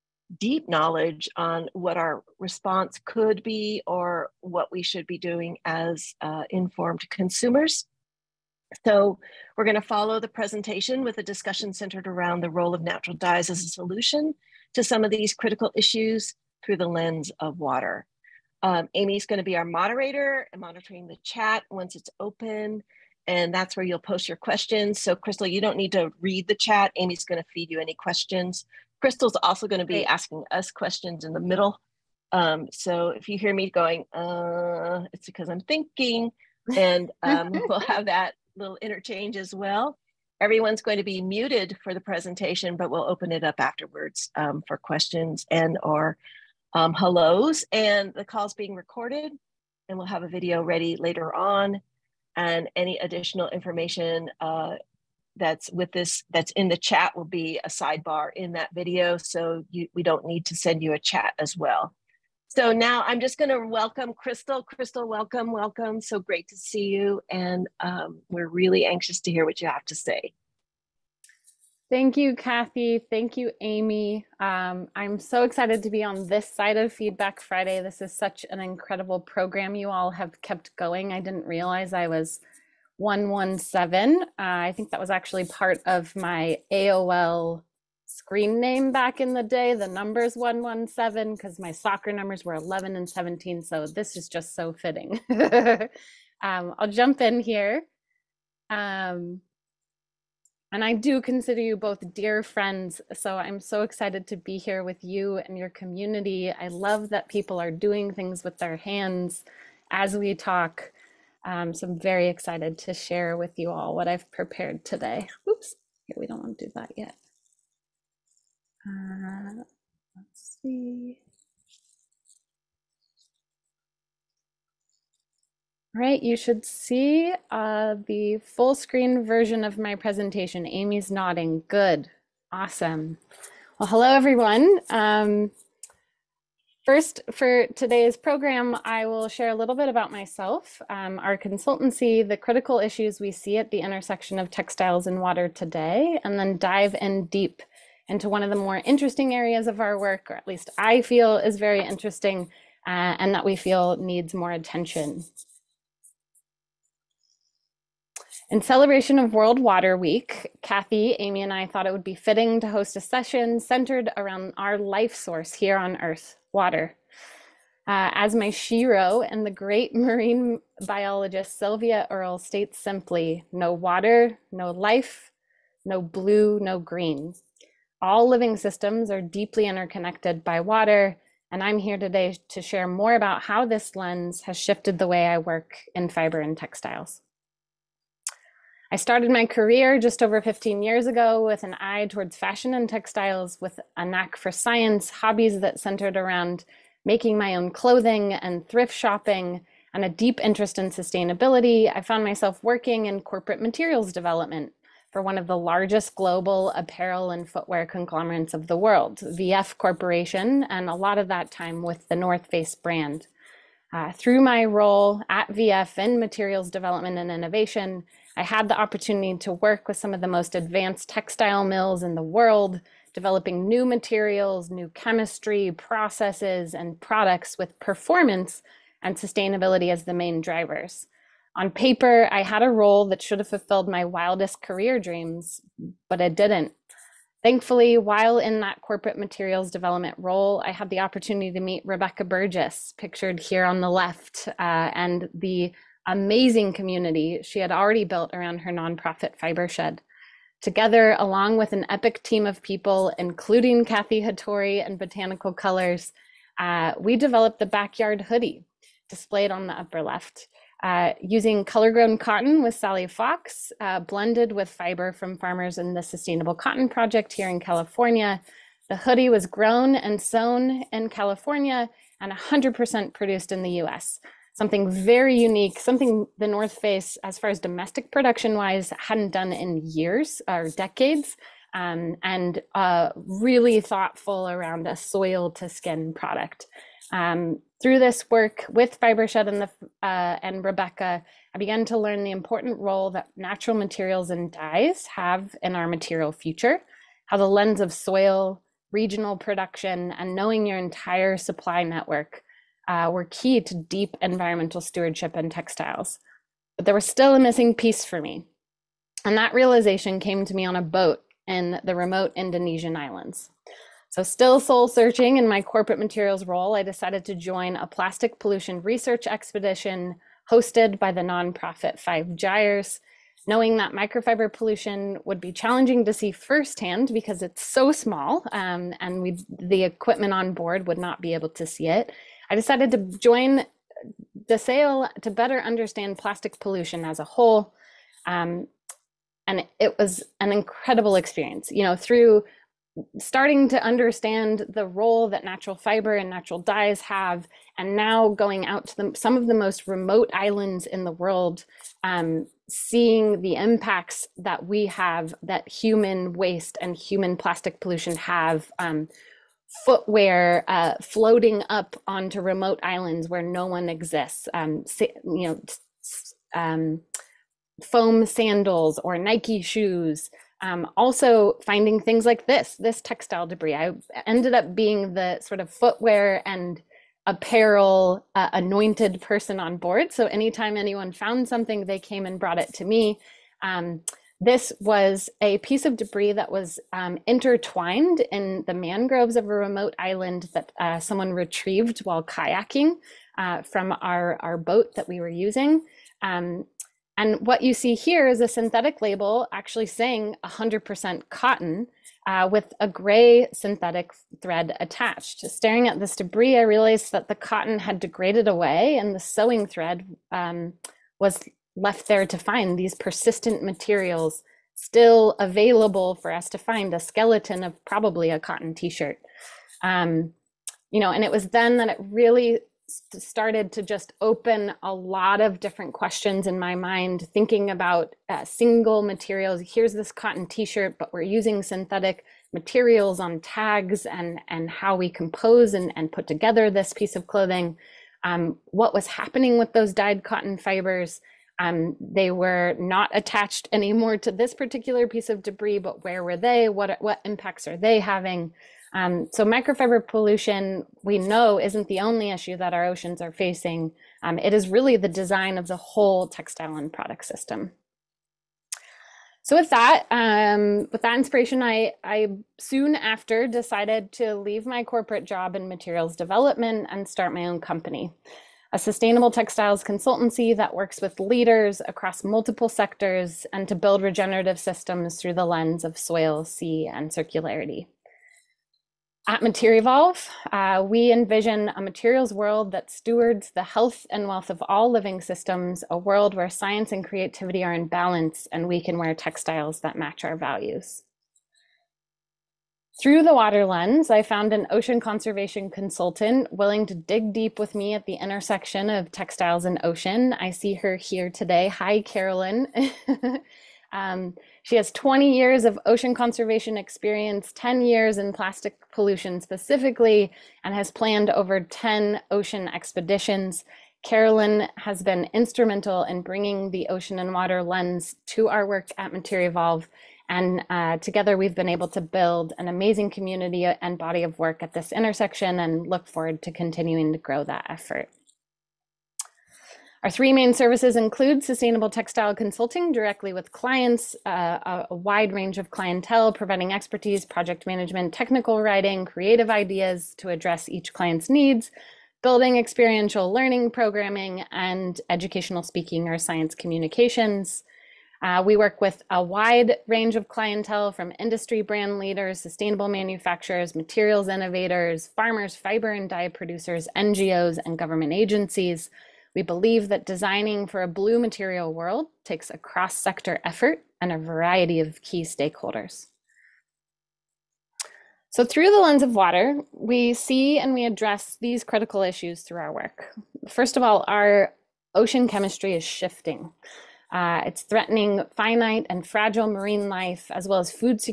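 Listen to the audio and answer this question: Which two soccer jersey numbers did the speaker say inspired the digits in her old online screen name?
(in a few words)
11 and 17.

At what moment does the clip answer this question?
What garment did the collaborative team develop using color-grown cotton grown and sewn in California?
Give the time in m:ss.
4:17.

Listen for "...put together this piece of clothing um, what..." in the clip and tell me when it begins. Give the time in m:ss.
7:16.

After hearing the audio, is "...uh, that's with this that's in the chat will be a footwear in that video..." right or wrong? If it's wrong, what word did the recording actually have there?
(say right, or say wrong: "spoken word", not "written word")
wrong: "sidebar", not "footwear".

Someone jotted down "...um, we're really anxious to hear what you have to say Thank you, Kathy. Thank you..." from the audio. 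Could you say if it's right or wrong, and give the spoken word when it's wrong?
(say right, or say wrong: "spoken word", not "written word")
right.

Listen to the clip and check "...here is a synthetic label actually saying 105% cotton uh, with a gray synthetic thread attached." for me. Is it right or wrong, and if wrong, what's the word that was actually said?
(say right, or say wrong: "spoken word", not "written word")
wrong: "100", not "105".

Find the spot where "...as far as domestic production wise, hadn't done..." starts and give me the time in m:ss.
4:37.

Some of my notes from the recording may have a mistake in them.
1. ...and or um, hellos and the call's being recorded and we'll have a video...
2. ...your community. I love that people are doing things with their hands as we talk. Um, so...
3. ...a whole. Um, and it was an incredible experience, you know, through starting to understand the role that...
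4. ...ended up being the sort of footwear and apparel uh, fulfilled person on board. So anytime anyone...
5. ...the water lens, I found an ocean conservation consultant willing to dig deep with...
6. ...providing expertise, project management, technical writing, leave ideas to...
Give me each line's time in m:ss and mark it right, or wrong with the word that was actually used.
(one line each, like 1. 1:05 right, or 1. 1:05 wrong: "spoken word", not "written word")
1. 0:45 right
2. 1:45 right
3. 5:37 right
4. 6:14 wrong: "anointed", not "fulfilled"
5. 8:13 right
6. 8:56 wrong: "creative", not "leave".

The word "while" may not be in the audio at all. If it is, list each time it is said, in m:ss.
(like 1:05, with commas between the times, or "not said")
3:57, 6:32.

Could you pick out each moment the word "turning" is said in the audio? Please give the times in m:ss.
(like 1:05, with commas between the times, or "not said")
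not said.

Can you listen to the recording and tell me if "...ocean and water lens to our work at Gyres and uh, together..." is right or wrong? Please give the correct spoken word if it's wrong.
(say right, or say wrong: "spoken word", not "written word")
wrong: "Evolve", not "Gyres".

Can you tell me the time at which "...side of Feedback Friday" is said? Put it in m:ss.
1:16.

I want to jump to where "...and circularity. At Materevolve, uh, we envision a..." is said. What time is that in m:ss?
7:56.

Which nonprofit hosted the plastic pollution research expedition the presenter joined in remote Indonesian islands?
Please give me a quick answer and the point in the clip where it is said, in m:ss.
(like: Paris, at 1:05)
Five Gyres, at 5:22.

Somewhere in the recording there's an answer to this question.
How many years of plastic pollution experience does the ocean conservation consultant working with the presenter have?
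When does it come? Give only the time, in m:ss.
8:27.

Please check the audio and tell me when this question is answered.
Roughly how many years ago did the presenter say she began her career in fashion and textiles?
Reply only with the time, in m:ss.
3:10.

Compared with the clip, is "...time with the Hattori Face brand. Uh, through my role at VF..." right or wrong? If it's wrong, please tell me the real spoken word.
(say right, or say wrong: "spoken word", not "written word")
wrong: "North", not "Hattori".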